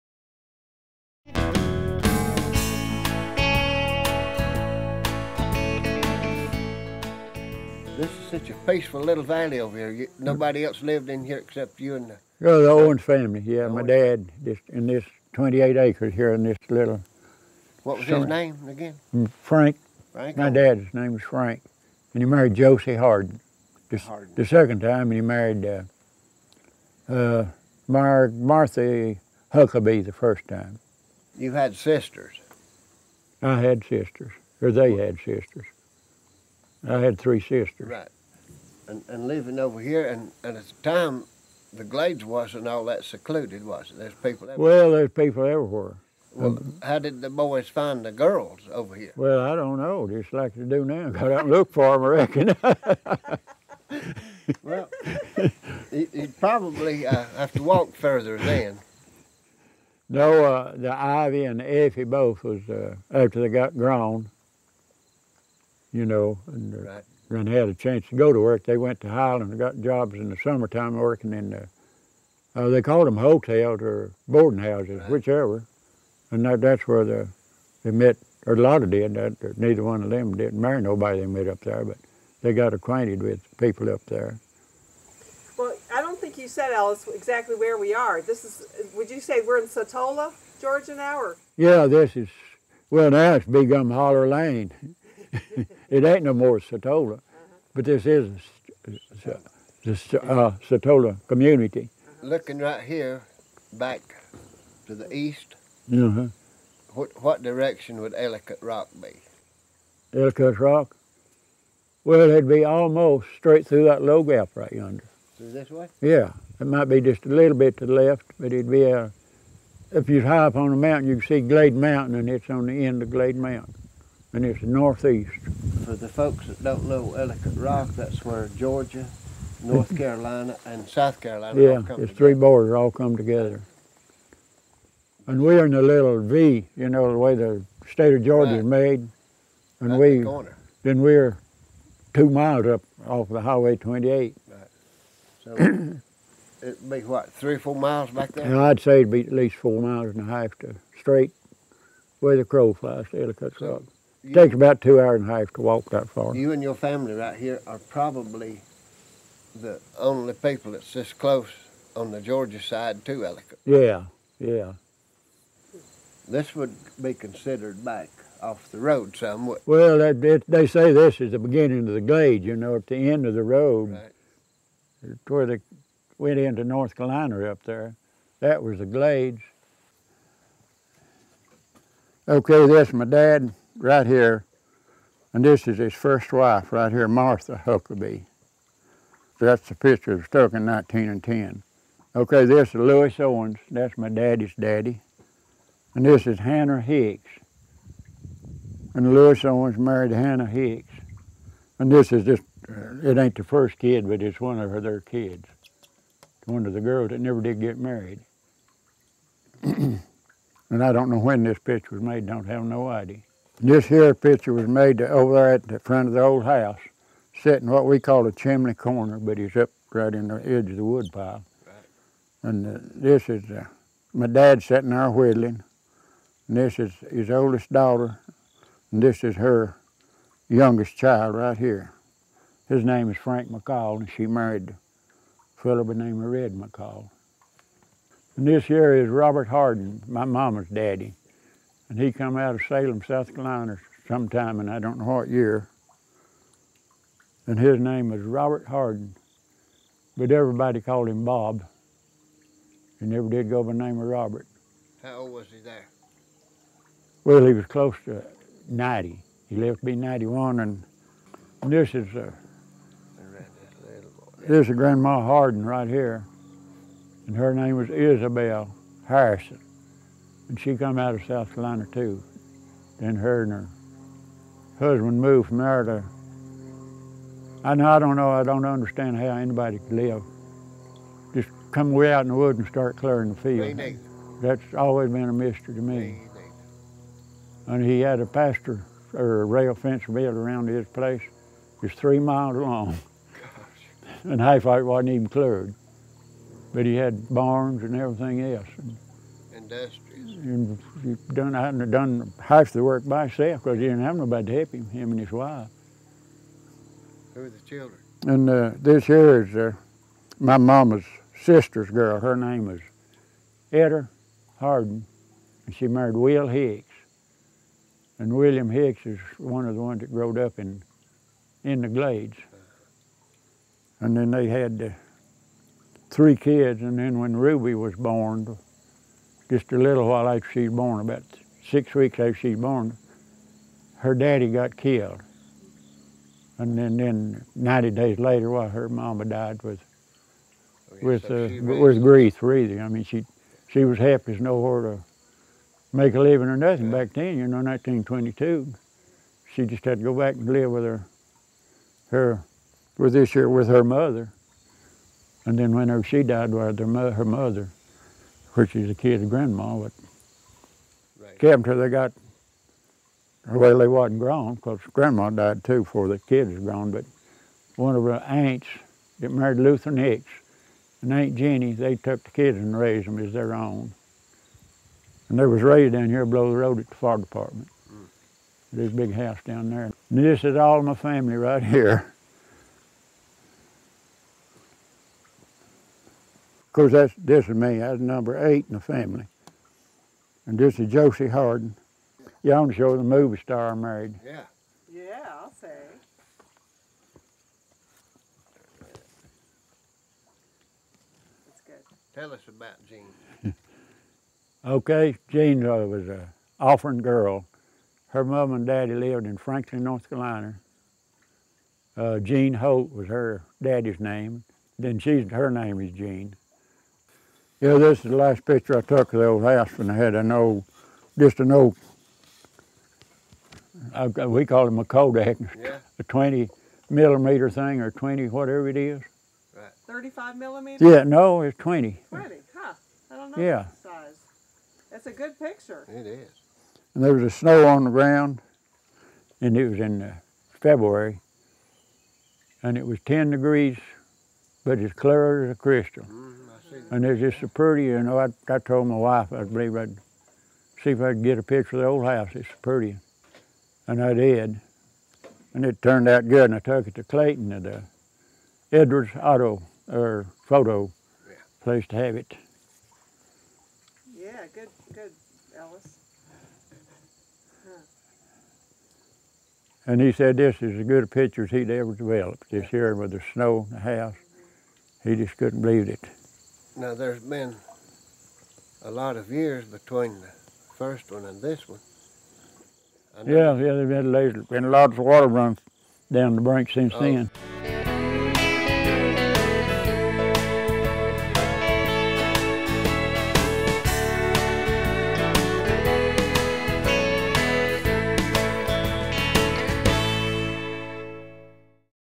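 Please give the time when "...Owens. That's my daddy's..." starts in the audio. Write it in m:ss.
3:13.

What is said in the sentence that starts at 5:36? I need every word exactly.
And then, then 90 days later, while her mama died with okay, oh, with so uh, with grief, really.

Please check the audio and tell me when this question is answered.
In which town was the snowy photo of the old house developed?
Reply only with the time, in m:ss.
7:37.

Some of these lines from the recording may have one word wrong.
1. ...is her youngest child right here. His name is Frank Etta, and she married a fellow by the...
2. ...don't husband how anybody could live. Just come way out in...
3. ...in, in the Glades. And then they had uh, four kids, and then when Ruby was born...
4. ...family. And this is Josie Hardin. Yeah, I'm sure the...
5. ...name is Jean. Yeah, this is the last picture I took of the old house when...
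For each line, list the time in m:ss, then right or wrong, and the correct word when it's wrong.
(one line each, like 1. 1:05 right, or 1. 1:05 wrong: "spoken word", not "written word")
1. 3:49 wrong: "McCall", not "Etta"
2. 4:38 wrong: "understand", not "husband"
3. 5:20 wrong: "three", not "four"
4. 6:28 right
5. 6:55 right.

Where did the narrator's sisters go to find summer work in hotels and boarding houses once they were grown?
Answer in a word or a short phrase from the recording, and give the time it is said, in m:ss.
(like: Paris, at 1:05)
Highland, at 1:09.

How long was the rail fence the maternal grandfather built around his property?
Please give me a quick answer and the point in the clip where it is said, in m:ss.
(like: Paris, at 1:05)
3 miles, at 4:51.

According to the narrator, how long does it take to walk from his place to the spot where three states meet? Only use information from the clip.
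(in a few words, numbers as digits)
two hours and a half.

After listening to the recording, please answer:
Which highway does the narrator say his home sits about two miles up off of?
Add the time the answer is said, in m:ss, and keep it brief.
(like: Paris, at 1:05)
Highway 28, at 2:23.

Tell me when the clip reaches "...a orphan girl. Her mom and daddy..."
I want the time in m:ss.
6:46.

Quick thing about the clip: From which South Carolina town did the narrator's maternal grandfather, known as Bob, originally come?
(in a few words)
Salem.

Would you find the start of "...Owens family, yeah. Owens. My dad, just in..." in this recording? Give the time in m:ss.
0:12.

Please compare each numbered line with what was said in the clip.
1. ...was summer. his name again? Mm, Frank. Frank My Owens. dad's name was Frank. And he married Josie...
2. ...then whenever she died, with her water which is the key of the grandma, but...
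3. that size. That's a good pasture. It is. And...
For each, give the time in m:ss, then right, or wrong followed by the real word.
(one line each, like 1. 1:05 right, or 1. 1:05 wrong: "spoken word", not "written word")
1. 0:17 right
2. 5:55 wrong: "mother", not "water"
3. 7:13 wrong: "picture", not "pasture".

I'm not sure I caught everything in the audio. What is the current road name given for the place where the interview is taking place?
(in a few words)
Big Gum Holler Lane.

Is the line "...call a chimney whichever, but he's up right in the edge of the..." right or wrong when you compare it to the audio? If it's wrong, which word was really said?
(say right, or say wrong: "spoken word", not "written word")
wrong: "corner", not "whichever".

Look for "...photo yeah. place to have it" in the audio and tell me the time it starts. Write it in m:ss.
7:40.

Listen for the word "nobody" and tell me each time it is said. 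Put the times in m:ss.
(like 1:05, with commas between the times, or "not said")
0:10, 1:20, 5:04.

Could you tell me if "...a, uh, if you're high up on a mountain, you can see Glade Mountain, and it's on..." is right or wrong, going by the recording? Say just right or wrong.
right.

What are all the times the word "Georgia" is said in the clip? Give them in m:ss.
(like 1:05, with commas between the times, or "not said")
1:30, 2:08, 2:18, 2:42.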